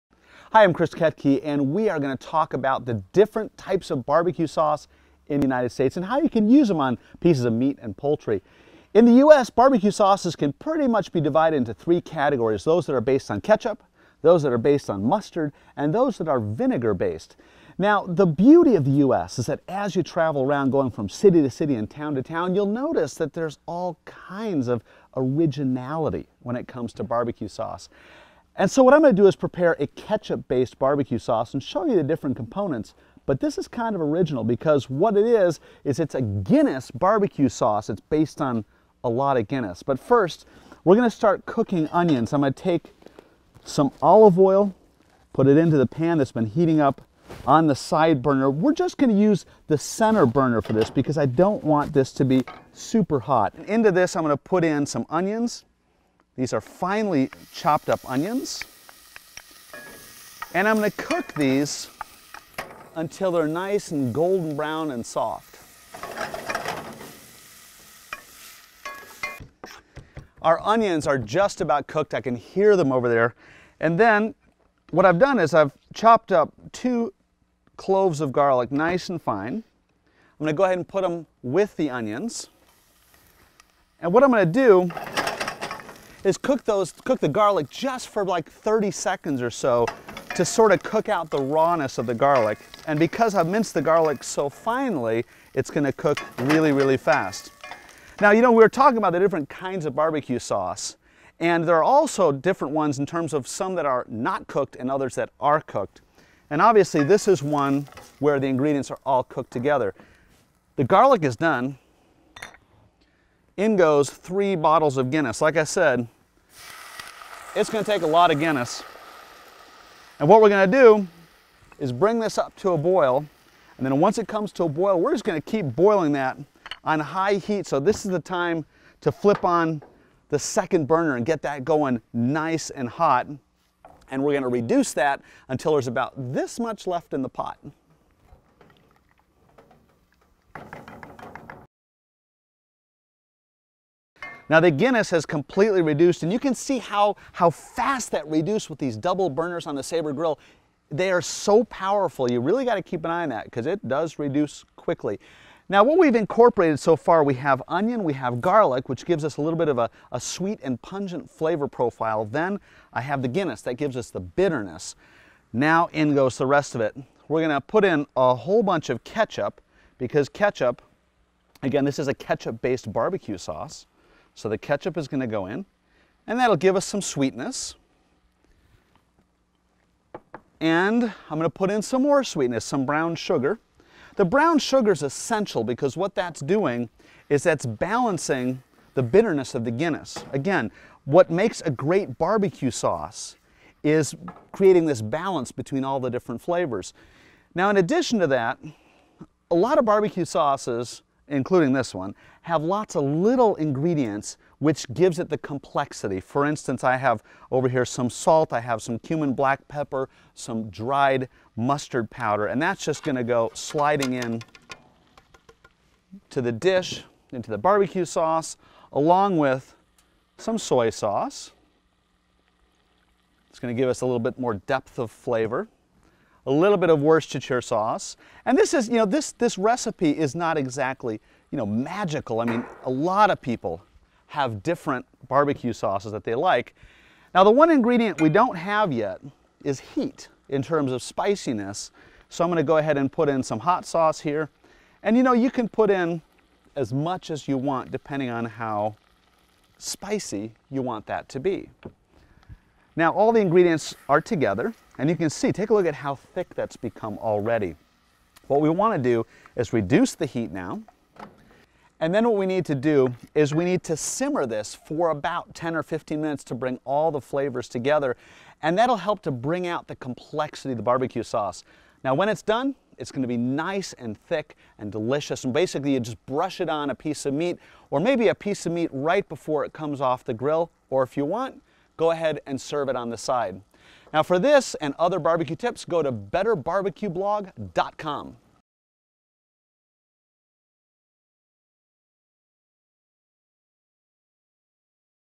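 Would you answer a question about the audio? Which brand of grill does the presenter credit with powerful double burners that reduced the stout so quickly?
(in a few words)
Saber.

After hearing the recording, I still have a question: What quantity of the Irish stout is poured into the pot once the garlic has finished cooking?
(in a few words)
3 bottles.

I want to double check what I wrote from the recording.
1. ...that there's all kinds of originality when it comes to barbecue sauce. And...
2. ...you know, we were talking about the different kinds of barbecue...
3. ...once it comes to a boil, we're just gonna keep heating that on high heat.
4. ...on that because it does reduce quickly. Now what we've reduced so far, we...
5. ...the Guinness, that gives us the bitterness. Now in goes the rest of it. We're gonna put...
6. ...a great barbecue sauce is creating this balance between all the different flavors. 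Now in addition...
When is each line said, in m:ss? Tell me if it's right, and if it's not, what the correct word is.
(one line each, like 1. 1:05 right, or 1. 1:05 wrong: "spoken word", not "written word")
1. 0:23 right
2. 1:38 right
3. 2:03 wrong: "boiling", not "heating"
4. 2:33 wrong: "incorporated", not "reduced"
5. 2:43 right
6. 3:11 right.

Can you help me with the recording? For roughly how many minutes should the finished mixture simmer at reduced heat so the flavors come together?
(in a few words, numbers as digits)
10 or 15 minutes.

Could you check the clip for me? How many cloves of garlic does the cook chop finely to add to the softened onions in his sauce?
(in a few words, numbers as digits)
2.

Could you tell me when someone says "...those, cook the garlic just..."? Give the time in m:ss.
1:26.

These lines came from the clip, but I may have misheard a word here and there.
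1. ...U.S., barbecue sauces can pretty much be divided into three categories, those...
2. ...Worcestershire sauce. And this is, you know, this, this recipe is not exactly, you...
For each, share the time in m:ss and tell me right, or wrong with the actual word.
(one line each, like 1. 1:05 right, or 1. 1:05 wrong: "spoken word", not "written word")
1. 0:09 right
2. 3:47 right.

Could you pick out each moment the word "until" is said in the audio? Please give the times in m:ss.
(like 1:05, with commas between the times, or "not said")
1:02, 2:15.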